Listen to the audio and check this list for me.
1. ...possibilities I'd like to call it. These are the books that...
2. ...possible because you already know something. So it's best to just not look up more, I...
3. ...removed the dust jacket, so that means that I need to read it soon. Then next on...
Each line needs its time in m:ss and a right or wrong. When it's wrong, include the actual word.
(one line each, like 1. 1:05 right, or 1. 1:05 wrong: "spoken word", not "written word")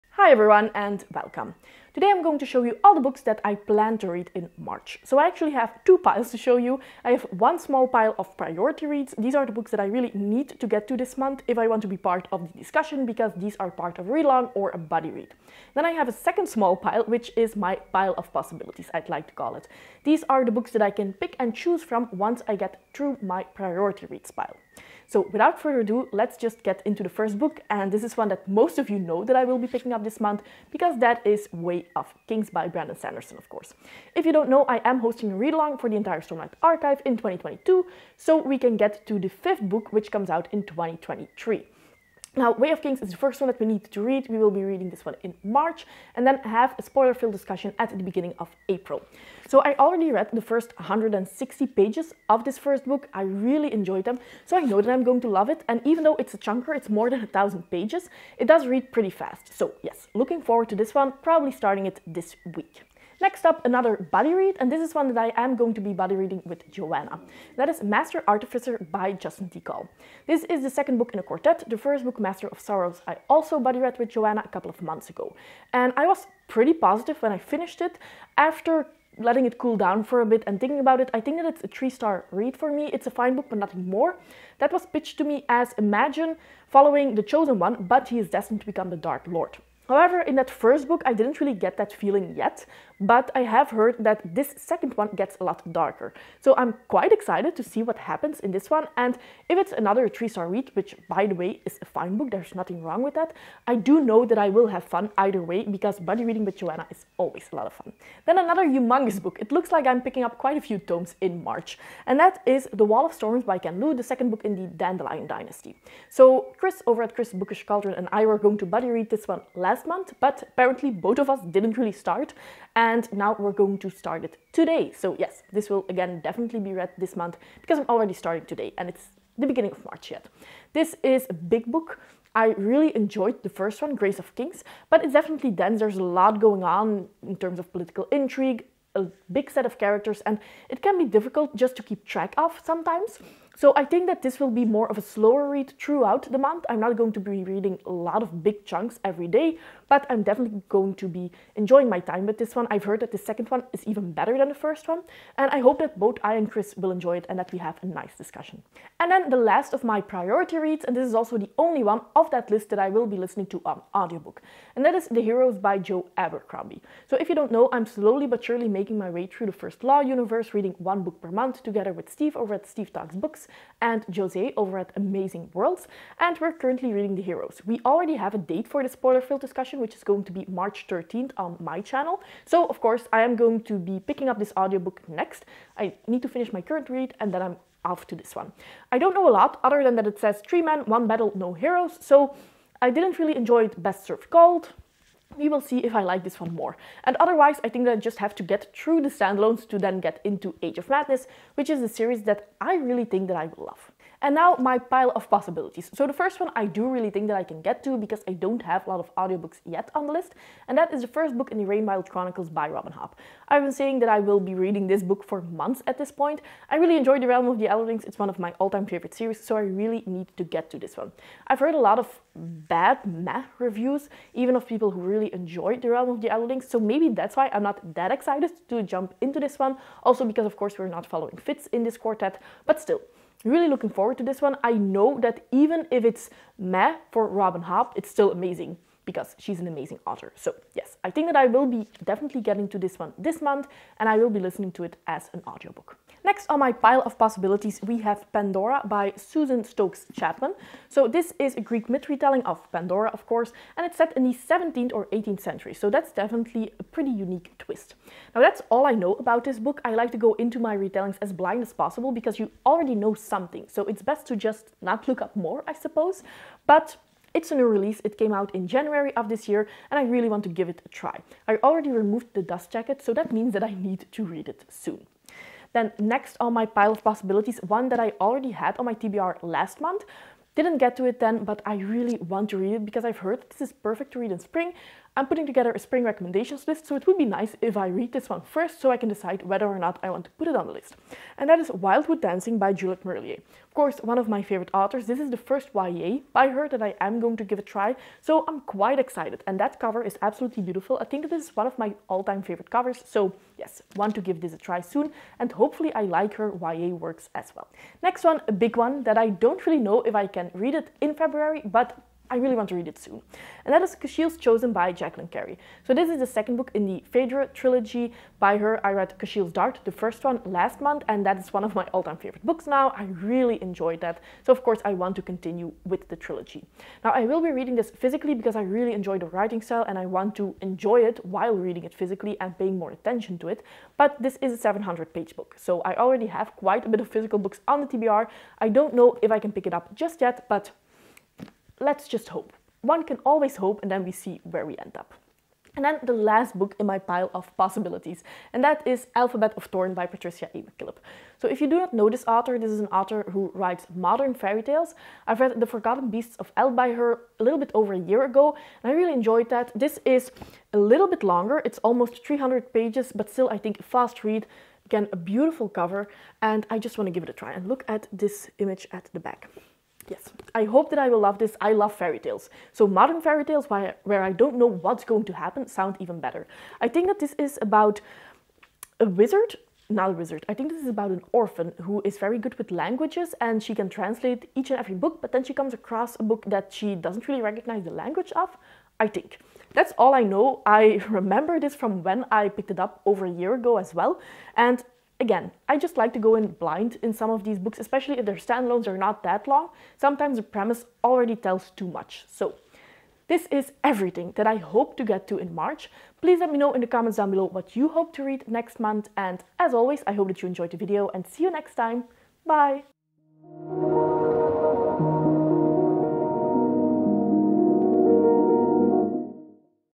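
1. 0:18 right
2. 4:21 right
3. 4:31 right.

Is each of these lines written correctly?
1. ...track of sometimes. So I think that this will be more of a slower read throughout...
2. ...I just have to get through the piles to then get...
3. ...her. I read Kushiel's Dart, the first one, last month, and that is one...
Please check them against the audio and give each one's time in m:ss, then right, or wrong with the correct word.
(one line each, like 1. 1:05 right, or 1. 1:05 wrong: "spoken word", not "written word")
1. 2:22 right
2. 3:17 wrong: "standalones", not "piles"
3. 5:18 right.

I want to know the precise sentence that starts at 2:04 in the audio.
So yes, this will again definitely be read this month because I'm already starting today, and it's the beginning of March yet.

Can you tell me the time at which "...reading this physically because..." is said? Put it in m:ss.
5:27.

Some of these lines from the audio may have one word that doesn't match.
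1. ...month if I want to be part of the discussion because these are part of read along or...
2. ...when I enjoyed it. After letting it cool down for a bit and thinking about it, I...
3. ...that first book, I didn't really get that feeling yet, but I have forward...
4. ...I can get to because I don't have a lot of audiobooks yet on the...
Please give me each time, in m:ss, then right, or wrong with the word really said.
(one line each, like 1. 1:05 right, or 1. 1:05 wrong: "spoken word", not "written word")
1. 0:11 right
2. 1:17 wrong: "finished", not "enjoyed"
3. 1:30 wrong: "heard", not "forward"
4. 3:27 right.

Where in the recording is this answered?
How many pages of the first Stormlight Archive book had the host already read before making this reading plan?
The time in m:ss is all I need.
0:50.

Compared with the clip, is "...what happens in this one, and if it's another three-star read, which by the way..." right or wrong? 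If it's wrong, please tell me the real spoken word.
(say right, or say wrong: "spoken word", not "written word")
right.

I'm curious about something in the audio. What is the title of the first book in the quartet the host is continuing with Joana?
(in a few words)
Master of Sorrows.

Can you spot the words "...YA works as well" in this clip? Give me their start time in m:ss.
5:06.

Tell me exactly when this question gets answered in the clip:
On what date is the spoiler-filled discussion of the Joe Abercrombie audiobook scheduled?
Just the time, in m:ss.
3:00.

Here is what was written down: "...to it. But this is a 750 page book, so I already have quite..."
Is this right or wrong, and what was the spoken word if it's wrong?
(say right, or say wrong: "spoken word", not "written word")
wrong: "700", not "750".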